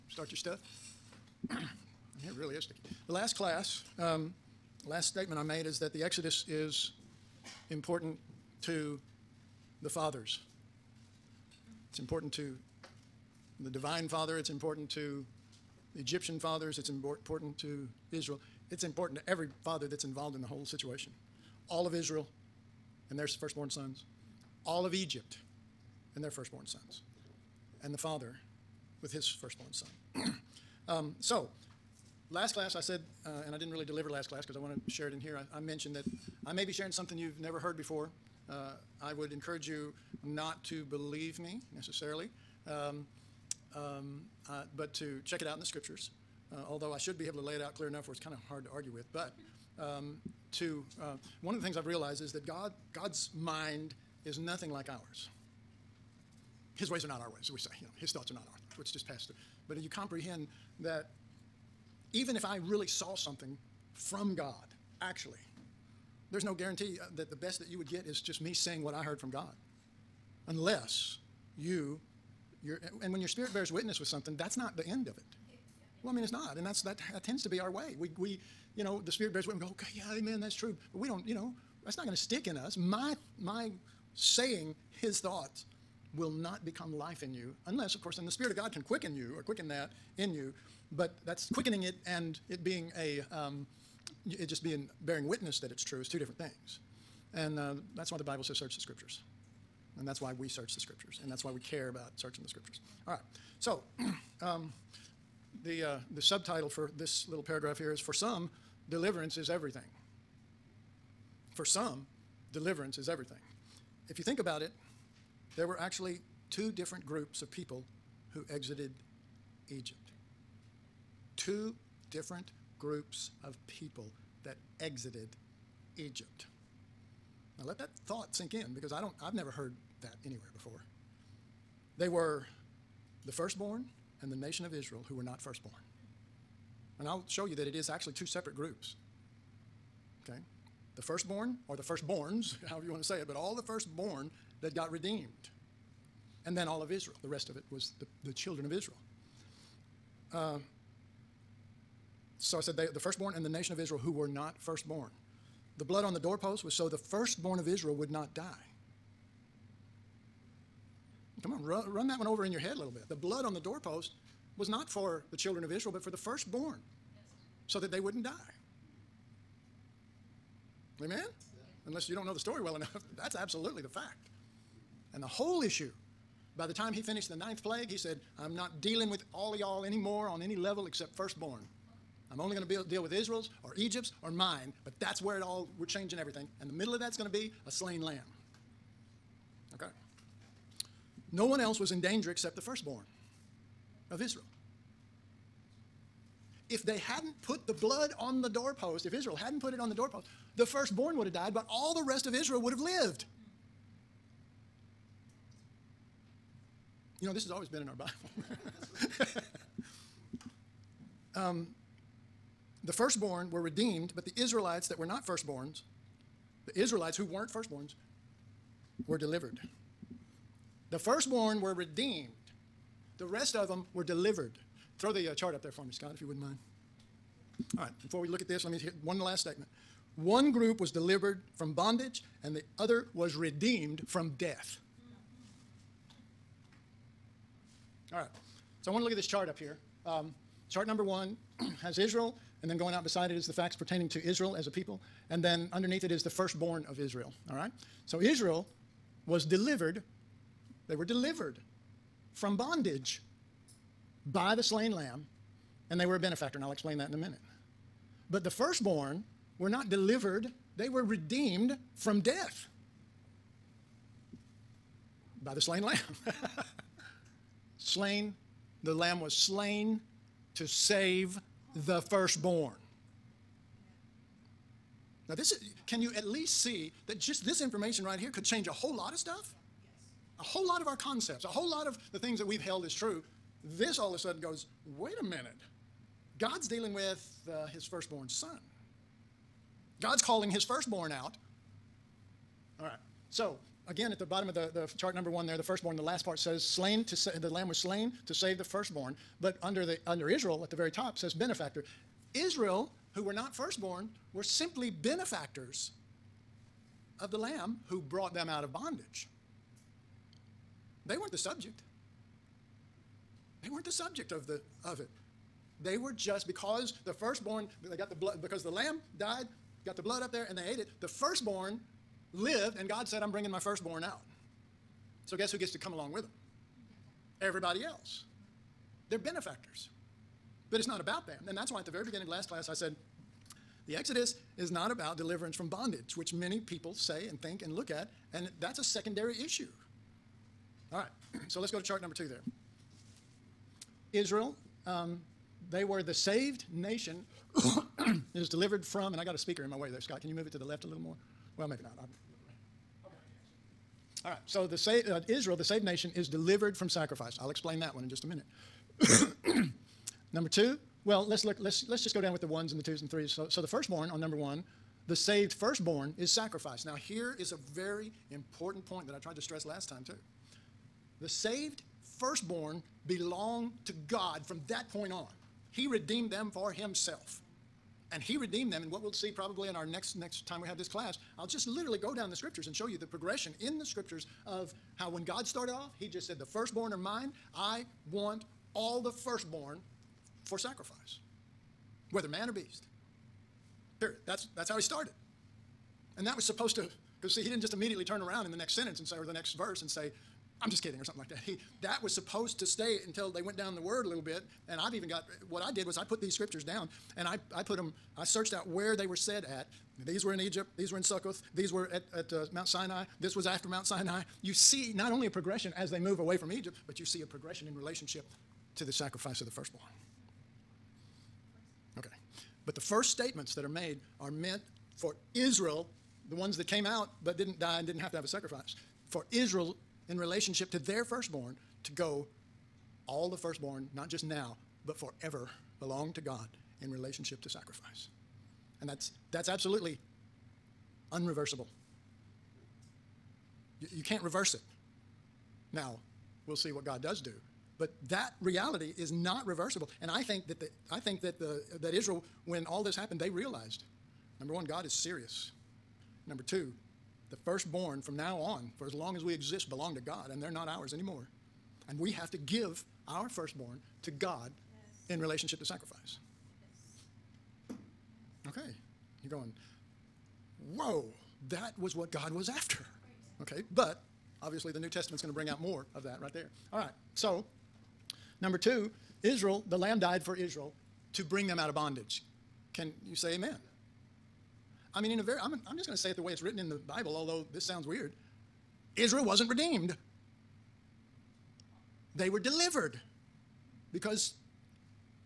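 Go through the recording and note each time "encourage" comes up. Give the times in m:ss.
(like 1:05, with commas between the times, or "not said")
0:39.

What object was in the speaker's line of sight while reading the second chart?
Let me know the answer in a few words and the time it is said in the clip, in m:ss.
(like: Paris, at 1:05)
a speaker, at 5:49.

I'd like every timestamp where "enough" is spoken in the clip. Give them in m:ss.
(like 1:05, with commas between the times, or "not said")
0:47, 2:52.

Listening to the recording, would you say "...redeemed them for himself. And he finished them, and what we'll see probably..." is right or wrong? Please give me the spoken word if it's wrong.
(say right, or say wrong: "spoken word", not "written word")
wrong: "redeemed", not "finished".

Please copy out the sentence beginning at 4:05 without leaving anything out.
And then underneath it is the firstborn of Israel.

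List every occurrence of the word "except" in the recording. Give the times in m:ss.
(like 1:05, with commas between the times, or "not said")
3:00, 3:12.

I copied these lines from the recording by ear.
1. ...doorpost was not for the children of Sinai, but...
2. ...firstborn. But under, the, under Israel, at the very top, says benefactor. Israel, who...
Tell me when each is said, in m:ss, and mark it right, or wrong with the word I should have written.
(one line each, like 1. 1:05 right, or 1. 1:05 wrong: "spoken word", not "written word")
1. 2:43 wrong: "Israel", not "Sinai"
2. 4:58 right.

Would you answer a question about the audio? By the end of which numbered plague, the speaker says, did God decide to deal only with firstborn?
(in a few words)
ninth.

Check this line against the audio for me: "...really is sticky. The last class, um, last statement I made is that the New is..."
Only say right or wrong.
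wrong.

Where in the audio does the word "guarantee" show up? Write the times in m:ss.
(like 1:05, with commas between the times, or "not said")
1:06.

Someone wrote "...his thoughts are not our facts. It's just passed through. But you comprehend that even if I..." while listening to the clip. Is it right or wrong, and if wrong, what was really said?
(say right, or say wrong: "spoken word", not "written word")
wrong: "thoughts", not "facts".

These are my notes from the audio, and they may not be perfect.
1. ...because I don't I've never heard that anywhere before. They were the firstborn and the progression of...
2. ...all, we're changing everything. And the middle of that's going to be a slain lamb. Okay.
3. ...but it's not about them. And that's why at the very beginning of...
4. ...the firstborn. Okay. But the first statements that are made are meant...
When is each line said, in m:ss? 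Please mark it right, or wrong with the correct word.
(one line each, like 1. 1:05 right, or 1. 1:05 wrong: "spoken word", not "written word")
1. 2:08 wrong: "nation", not "progression"
2. 3:05 right
3. 5:30 right
4. 6:59 right.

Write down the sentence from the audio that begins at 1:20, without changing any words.
But we don't, you know, that's not going to stick in us.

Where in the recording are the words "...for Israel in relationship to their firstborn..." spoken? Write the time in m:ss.
7:09.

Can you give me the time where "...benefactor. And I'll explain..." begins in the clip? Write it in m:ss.
4:16.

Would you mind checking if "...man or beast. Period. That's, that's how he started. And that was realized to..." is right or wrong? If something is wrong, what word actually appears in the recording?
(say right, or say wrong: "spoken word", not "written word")
wrong: "supposed", not "realized".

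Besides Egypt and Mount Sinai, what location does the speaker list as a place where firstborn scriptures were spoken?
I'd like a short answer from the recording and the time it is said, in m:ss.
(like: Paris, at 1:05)
Succoth, at 6:51.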